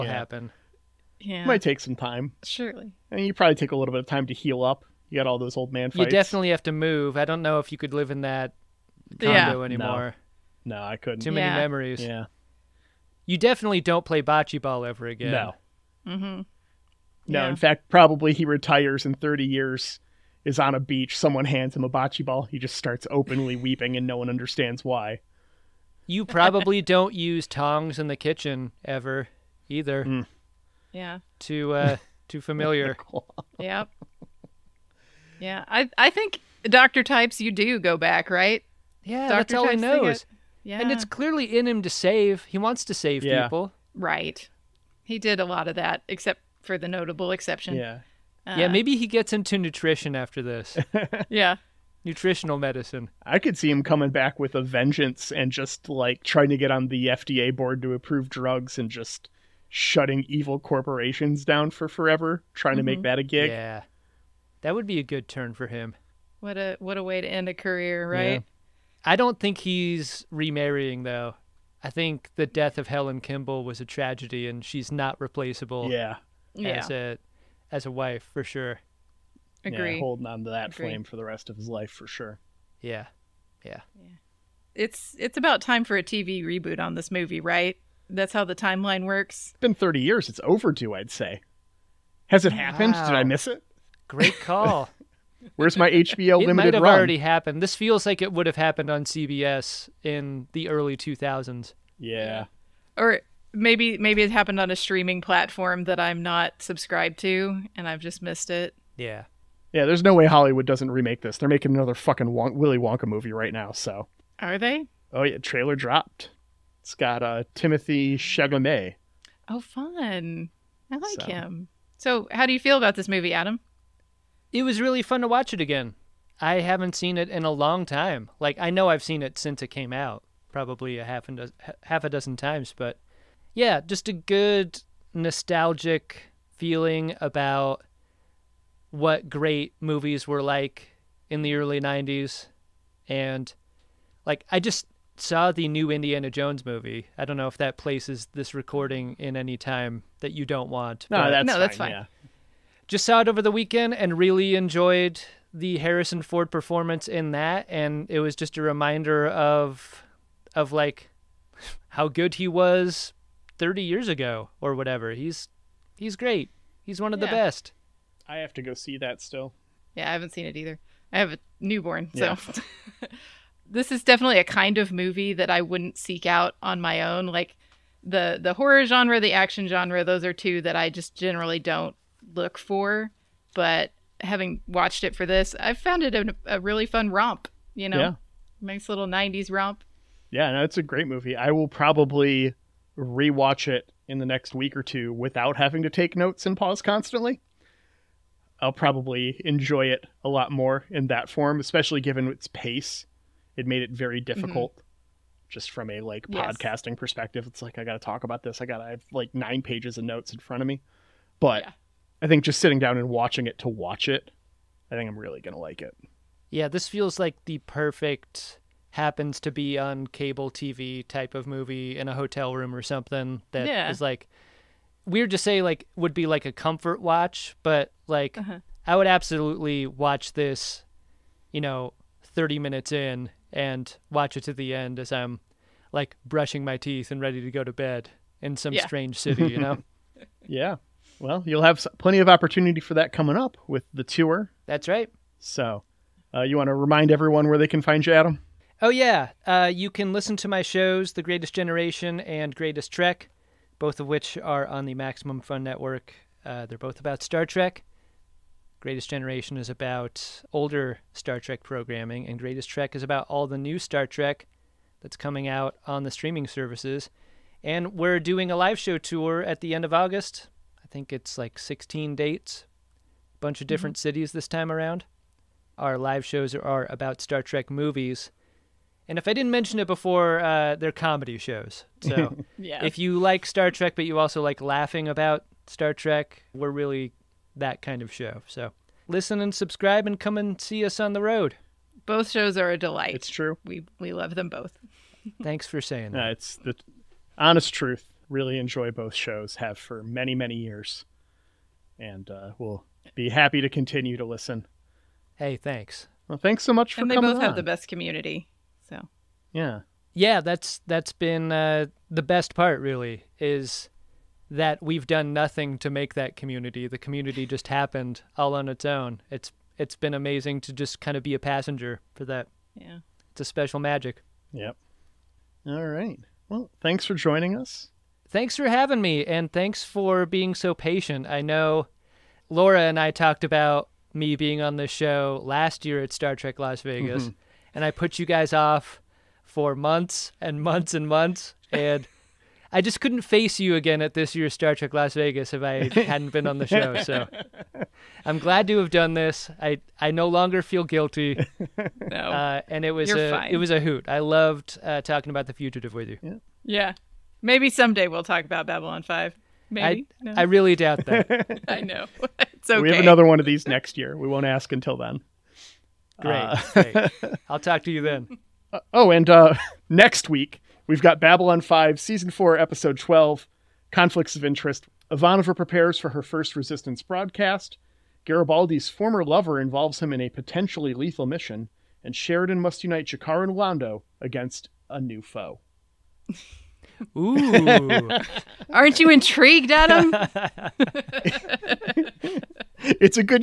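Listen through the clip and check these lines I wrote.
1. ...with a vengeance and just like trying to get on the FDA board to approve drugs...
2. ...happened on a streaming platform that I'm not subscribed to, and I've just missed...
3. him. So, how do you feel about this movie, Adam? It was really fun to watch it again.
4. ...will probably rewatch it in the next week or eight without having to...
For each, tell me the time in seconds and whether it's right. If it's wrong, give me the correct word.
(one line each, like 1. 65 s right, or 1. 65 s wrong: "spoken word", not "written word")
1. 54 s right
2. 104 s right
3. 121 s right
4. 191 s wrong: "two", not "eight".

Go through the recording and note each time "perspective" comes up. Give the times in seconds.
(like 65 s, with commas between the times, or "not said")
206 s.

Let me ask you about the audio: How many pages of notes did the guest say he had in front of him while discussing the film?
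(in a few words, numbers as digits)
9.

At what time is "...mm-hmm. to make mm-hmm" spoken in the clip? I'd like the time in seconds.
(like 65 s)
62 s.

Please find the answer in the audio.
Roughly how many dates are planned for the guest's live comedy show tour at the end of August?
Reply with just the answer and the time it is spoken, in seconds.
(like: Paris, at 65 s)
16, at 271 s.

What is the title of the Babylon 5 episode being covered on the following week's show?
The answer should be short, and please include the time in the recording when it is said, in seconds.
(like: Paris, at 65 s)
Conflicts of Interest, at 373 s.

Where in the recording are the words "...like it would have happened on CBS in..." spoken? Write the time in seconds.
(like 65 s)
98 s.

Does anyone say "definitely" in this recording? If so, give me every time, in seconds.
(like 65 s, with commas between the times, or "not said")
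6 s, 13 s, 174 s.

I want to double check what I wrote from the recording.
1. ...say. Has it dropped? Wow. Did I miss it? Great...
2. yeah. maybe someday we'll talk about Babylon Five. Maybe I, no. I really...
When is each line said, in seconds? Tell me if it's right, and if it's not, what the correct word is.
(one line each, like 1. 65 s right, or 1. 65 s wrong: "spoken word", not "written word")
1. 91 s wrong: "happened", not "dropped"
2. 356 s right.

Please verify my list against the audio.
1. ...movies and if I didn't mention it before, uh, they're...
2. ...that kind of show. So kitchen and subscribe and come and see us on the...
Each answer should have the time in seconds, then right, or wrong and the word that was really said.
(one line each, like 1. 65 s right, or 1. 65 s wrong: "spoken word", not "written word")
1. 277 s right
2. 287 s wrong: "listen", not "kitchen".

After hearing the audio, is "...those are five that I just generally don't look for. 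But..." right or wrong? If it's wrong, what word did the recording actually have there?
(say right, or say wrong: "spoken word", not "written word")
wrong: "two", not "five".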